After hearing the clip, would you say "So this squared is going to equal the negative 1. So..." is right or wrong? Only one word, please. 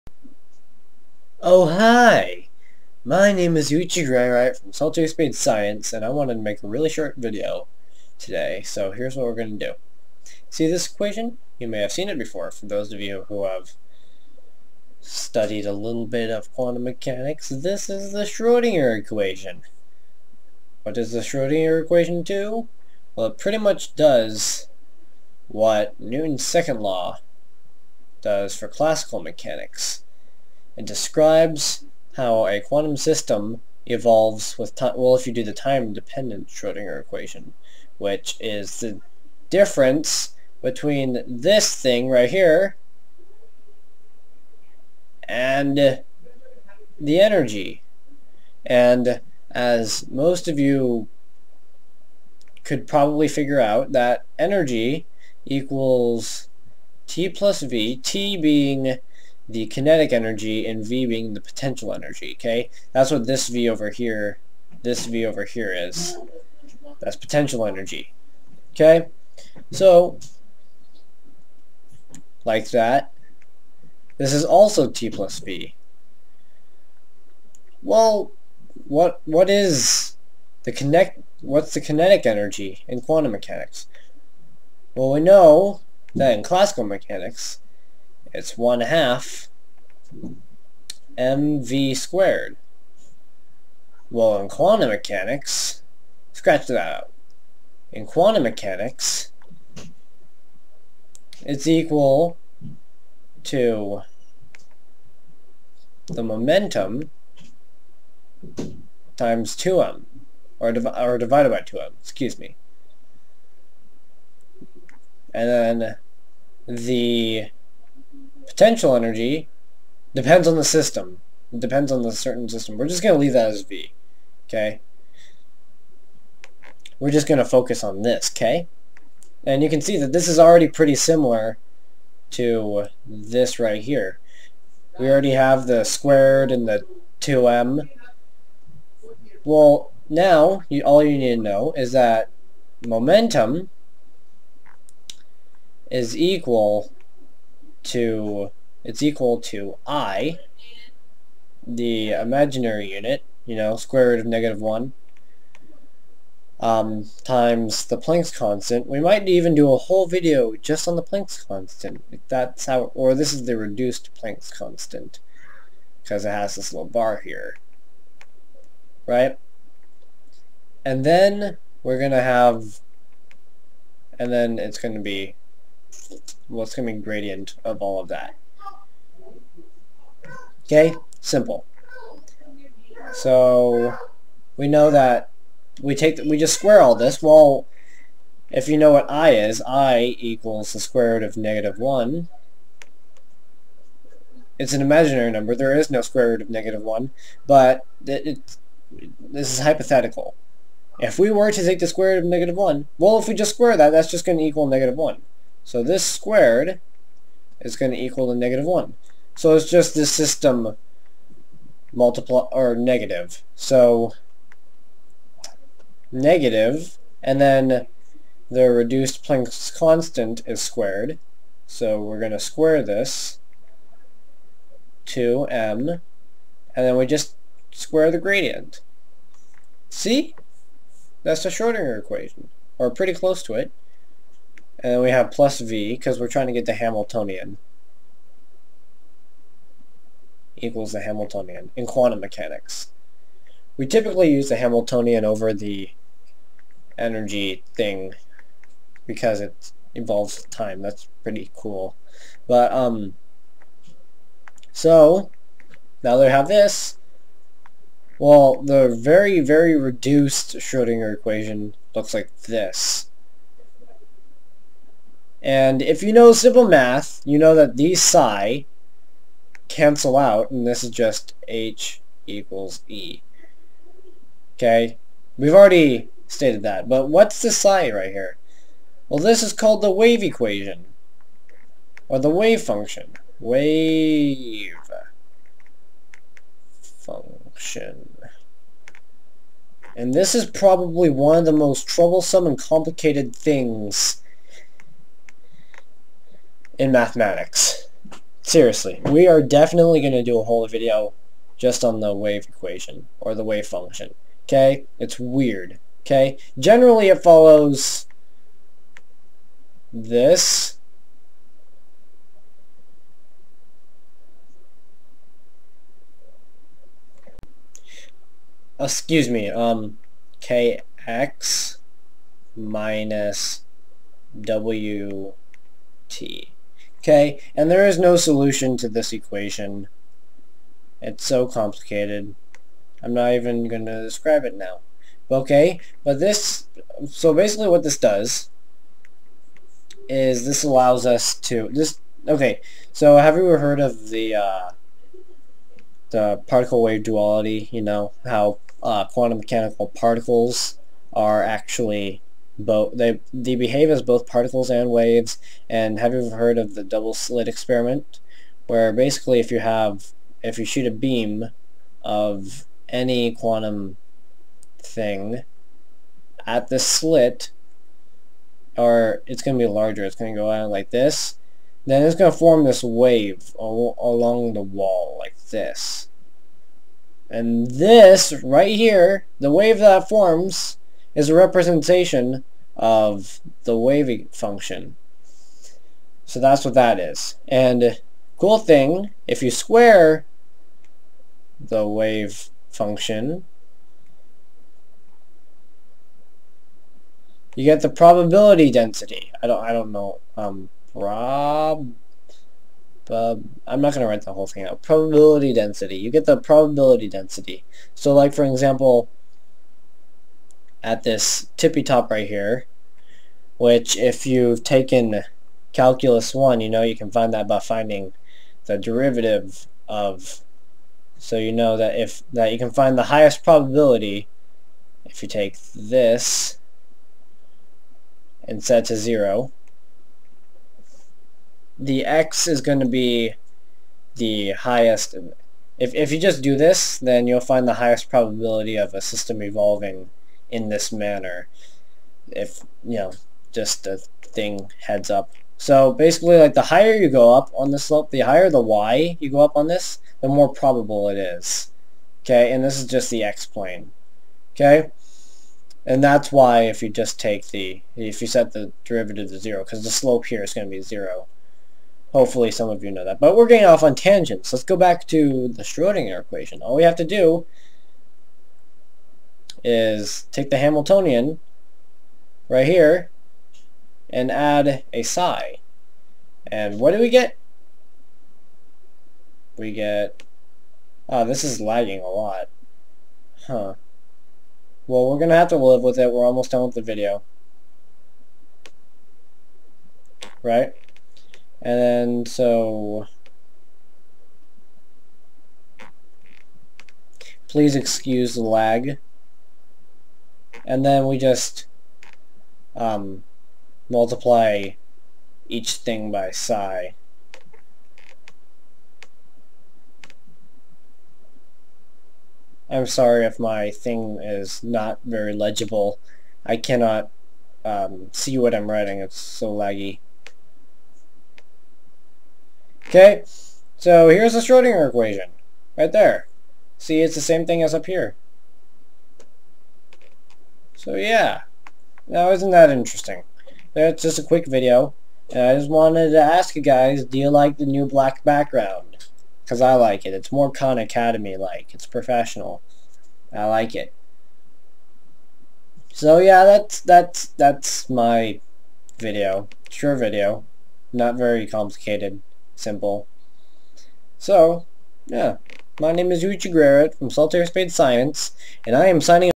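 right.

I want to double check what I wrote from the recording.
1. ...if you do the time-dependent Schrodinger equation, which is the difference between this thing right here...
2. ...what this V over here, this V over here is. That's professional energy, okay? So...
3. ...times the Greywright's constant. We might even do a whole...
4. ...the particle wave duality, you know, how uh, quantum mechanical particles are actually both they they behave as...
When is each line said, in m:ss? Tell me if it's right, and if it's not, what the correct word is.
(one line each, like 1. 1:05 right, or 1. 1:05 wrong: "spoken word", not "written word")
1. 0:35 right
2. 1:03 wrong: "potential", not "professional"
3. 2:37 wrong: "Planck", not "Greywright"
4. 5:46 right.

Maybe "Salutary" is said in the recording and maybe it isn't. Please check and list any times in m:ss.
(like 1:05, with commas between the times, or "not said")
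0:04, 9:17.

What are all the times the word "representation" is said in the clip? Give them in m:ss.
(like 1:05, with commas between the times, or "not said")
6:21.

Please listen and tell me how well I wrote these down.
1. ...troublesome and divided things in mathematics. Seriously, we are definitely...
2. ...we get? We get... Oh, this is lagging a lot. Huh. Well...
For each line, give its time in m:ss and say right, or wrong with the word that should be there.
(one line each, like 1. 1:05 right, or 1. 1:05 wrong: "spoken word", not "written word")
1. 4:51 wrong: "complicated", not "divided"
2. 7:56 right.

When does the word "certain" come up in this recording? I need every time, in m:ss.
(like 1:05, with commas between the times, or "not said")
2:02.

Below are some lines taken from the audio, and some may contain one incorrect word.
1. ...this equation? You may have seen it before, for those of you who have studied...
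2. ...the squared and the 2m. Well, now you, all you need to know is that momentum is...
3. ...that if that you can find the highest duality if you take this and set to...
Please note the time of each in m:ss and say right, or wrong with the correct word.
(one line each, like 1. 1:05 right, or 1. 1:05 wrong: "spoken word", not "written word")
1. 0:10 right
2. 2:15 right
3. 7:01 wrong: "probability", not "duality".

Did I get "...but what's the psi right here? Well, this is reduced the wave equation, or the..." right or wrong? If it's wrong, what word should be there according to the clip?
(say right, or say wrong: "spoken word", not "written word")
wrong: "called", not "reduced".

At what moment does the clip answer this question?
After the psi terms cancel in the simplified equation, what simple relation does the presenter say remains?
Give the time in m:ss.
4:31.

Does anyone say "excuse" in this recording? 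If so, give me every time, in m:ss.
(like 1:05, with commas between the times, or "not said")
1:52, 5:18, 8:17.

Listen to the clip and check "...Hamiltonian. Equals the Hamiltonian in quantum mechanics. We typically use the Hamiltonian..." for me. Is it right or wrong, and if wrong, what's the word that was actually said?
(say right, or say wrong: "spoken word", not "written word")
right.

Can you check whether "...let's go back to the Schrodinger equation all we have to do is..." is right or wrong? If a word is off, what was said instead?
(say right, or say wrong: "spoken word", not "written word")
right.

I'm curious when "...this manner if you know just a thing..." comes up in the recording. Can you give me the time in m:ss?
7:20.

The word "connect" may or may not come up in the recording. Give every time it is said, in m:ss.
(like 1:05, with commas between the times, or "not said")
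1:20.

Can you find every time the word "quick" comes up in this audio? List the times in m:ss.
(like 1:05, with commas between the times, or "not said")
8:54.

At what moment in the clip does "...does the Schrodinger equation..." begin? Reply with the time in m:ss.
0:20.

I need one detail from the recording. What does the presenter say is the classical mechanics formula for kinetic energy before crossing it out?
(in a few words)
1/2 mv squared.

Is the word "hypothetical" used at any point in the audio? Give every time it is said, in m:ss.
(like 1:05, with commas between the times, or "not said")
3:19.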